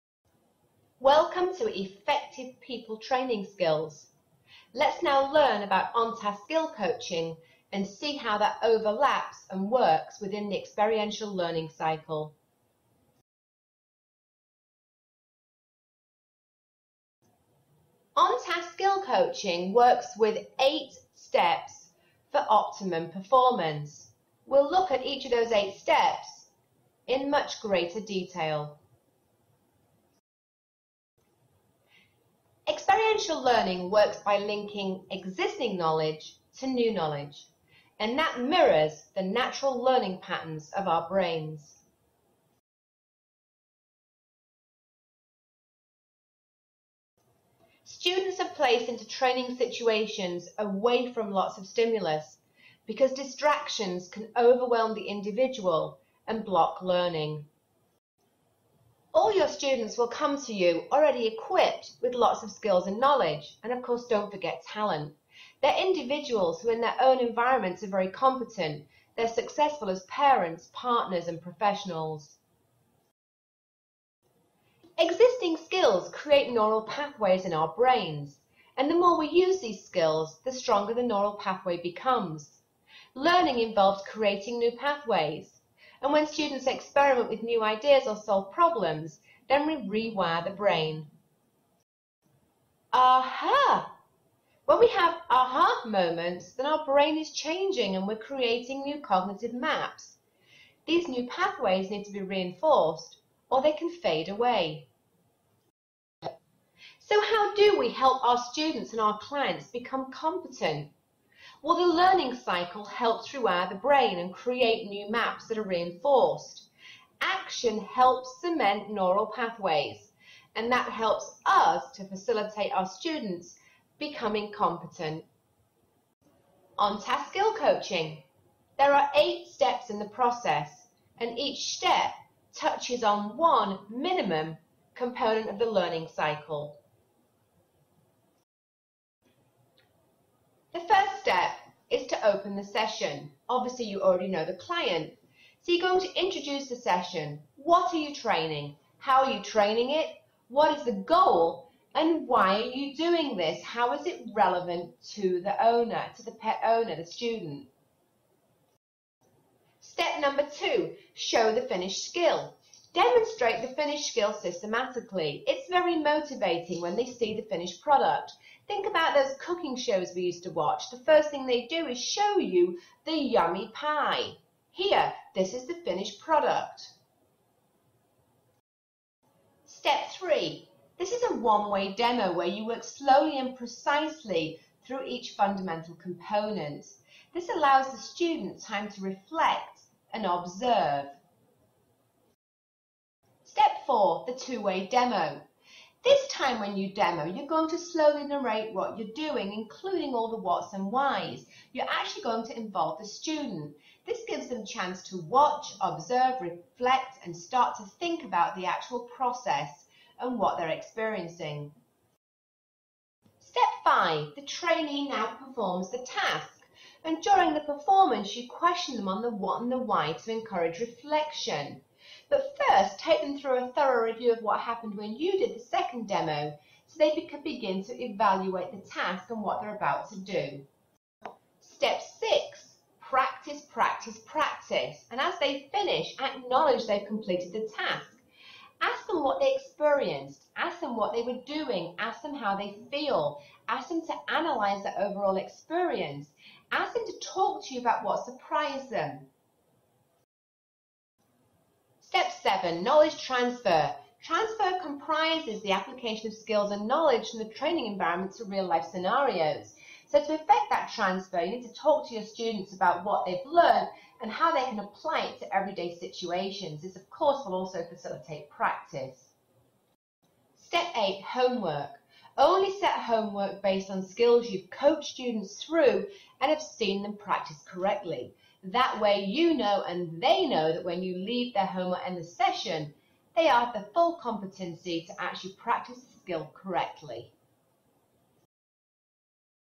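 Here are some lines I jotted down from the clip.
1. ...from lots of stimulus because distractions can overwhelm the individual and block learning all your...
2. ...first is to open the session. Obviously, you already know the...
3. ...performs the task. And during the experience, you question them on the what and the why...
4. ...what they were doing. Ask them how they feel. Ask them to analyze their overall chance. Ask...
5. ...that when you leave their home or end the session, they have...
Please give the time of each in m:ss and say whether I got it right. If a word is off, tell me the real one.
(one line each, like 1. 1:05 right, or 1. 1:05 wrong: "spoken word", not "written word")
1. 0:51 right
2. 2:20 right
3. 3:35 wrong: "performance", not "experience"
4. 4:00 wrong: "experience", not "chance"
5. 4:40 right.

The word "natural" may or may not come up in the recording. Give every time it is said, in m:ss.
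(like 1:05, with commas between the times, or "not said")
0:39.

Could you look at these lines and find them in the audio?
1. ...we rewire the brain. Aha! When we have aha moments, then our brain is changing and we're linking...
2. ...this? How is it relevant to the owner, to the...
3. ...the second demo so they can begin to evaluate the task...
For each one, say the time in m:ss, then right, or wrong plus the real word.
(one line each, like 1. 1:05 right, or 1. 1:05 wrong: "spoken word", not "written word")
1. 1:29 wrong: "creating", not "linking"
2. 2:33 right
3. 3:45 right.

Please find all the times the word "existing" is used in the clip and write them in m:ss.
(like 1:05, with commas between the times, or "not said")
0:35, 1:14.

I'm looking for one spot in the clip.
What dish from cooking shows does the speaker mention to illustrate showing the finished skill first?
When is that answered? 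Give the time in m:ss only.
2:53.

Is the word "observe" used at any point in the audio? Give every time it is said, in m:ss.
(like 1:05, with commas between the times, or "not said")
3:10, 3:25.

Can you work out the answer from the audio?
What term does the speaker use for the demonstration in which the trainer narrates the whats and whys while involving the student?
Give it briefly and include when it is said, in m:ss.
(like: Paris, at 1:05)
Two-way demo, at 3:14.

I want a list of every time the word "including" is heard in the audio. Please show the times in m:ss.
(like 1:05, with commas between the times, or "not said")
3:19.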